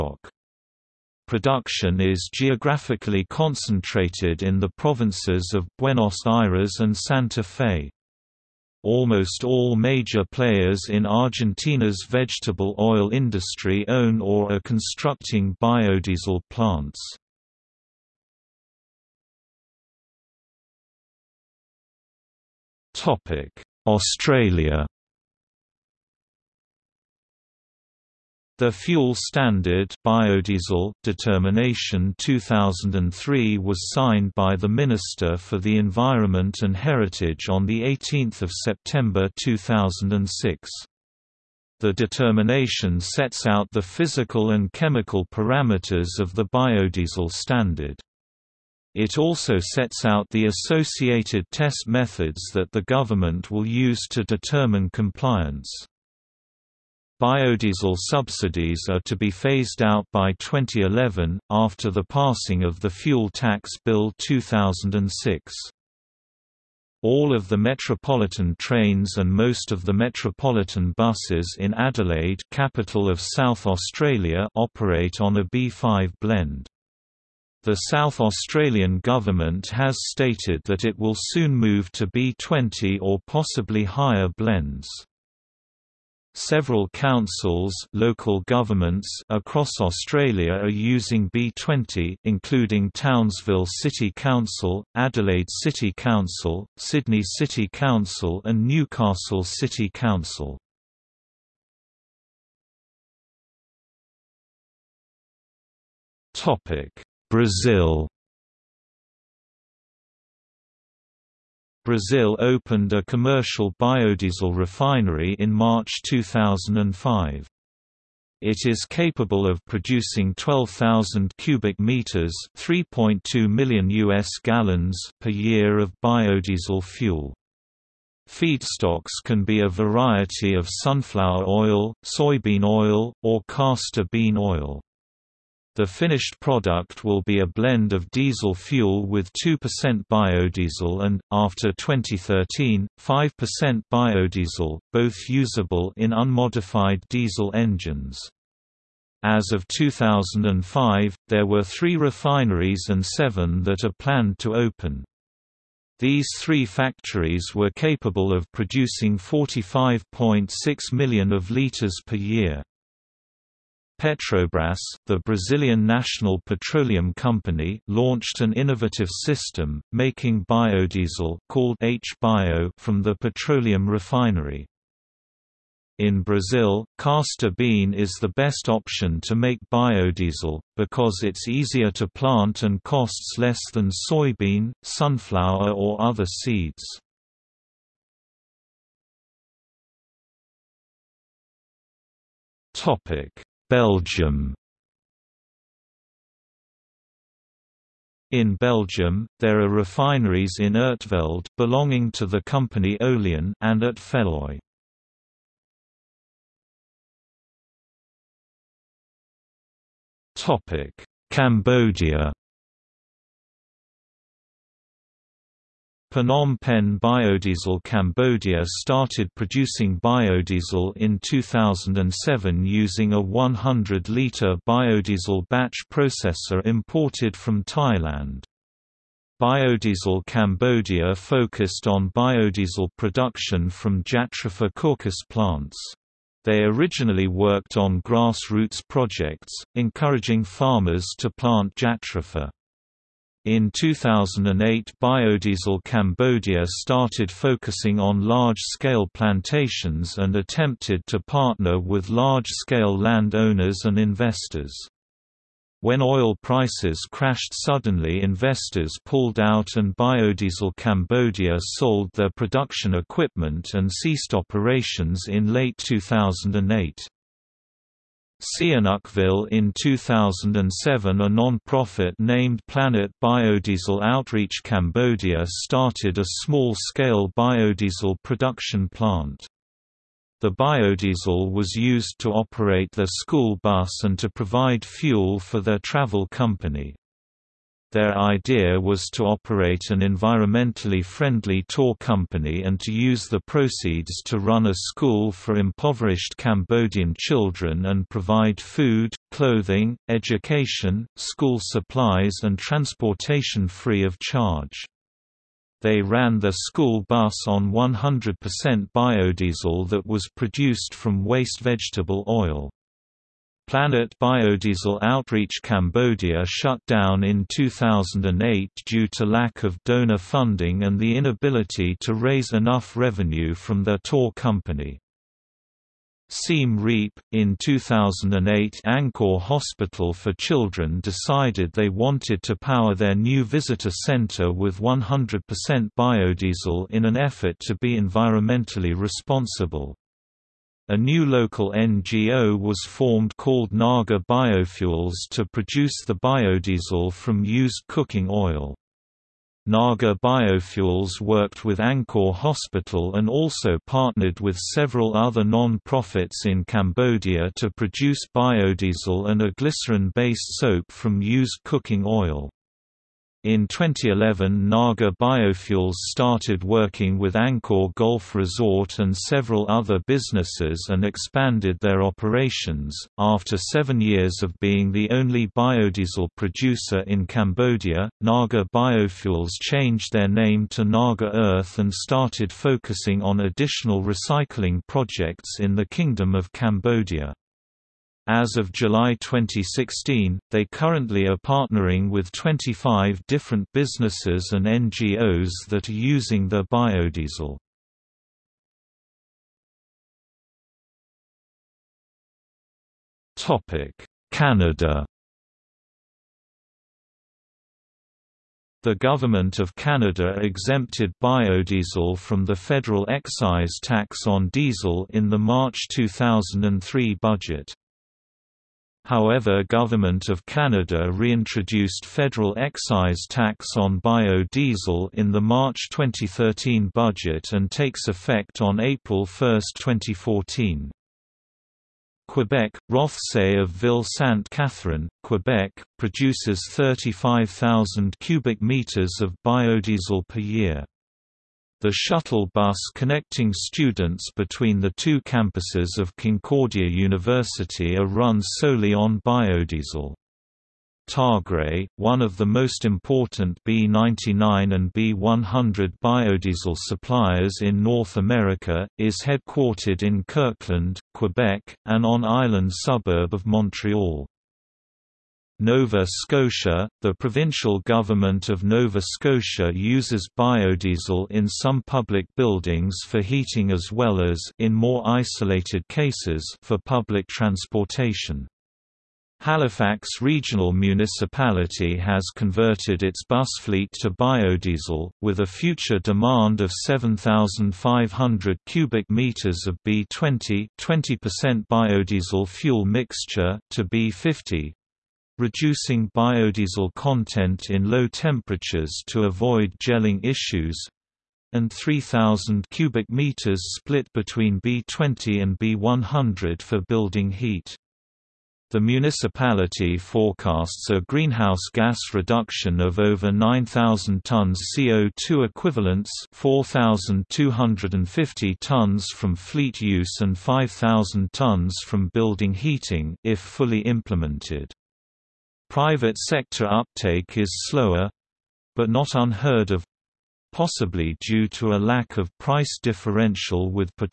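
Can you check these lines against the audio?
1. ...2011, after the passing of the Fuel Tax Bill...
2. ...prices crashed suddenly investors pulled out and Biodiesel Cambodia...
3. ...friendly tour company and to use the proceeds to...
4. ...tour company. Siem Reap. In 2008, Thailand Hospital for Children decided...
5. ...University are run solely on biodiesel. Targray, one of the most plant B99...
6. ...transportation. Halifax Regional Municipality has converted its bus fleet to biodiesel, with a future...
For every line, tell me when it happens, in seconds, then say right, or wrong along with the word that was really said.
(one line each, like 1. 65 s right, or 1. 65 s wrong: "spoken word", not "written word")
1. 60 s right
2. 256 s right
3. 291 s right
4. 323 s wrong: "Angkor", not "Thailand"
5. 446 s wrong: "important", not "plant"
6. 477 s right.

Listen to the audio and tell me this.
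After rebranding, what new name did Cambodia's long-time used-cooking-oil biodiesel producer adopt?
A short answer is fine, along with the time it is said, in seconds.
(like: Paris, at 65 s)
Naga Earth, at 380 s.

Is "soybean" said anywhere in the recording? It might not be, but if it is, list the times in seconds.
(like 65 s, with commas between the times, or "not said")
132 s, 184 s.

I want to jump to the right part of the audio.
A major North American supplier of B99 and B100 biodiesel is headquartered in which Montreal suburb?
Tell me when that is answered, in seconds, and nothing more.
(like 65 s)
460 s.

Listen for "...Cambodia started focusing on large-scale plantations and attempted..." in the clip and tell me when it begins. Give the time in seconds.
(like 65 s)
245 s.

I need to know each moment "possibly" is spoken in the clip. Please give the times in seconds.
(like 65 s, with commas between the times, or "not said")
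83 s, 530 s.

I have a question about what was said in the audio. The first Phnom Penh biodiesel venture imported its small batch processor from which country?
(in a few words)
Thailand.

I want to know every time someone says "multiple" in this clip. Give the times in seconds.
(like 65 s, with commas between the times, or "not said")
not said.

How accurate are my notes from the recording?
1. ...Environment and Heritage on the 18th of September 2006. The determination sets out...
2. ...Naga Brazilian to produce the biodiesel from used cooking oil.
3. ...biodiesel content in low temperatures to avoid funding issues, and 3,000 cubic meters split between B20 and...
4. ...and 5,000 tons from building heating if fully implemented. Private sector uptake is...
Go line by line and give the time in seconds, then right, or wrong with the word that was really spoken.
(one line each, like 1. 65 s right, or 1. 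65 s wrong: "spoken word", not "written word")
1. 35 s right
2. 343 s wrong: "Biofuels", not "Brazilian"
3. 496 s wrong: "gelling", not "funding"
4. 520 s right.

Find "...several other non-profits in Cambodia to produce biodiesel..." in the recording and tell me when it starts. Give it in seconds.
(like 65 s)
354 s.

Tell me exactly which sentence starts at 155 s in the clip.
These three factories were capable of producing 45.6 million of liters per year.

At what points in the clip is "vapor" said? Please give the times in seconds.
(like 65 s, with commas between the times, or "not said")
not said.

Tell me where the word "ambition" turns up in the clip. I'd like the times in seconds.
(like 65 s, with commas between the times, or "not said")
not said.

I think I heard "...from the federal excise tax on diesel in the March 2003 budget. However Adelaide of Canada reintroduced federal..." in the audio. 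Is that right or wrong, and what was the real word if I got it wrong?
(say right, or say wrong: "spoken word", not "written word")
wrong: "Government", not "Adelaide".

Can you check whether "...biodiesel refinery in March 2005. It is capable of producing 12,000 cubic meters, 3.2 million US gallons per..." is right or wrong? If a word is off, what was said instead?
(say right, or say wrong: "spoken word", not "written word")
right.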